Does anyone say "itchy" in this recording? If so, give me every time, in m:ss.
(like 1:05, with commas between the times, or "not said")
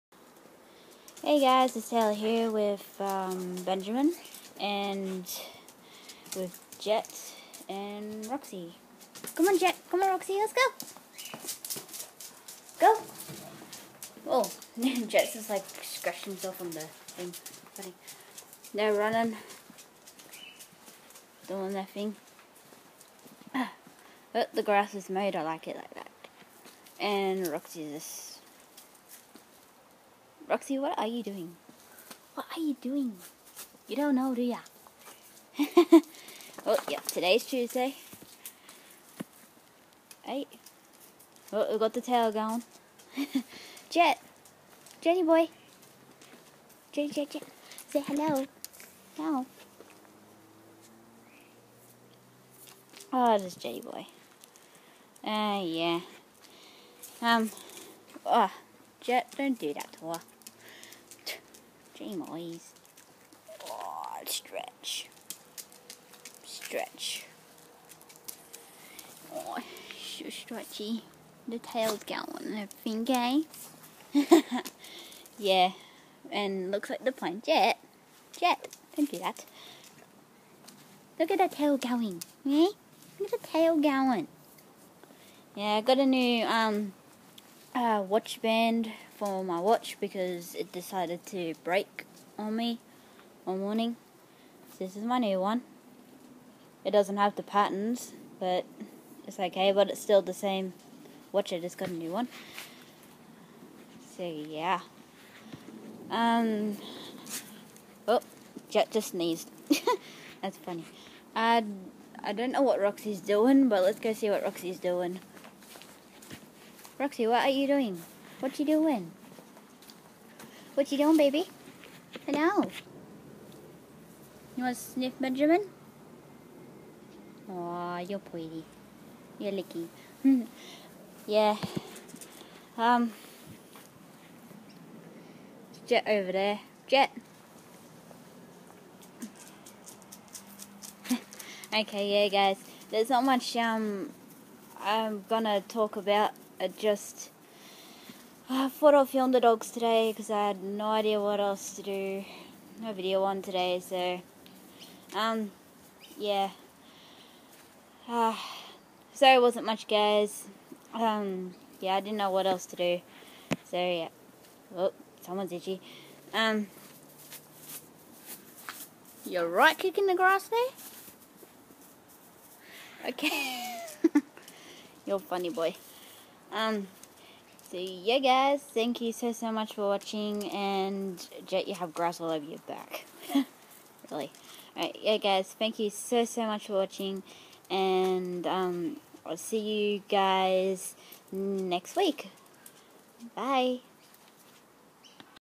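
2:45.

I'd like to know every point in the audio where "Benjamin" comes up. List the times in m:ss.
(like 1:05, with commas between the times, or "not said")
0:03, 2:05.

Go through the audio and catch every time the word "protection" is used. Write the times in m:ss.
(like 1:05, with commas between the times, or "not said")
not said.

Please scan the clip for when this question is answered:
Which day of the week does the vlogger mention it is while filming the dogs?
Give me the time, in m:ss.
0:37.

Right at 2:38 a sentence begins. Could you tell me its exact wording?
Uh, ah, sorry, it wasn't much, guys.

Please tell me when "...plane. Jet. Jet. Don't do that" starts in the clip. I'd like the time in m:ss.
1:17.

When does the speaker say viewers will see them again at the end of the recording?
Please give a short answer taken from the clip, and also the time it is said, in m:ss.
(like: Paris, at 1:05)
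next week, at 3:11.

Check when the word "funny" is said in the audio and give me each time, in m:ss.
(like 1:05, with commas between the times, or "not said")
0:17, 1:50, 2:55.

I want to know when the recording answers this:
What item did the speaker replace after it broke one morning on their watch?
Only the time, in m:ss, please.
1:28.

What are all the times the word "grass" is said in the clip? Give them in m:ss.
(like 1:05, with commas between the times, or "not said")
0:24, 2:50, 3:01.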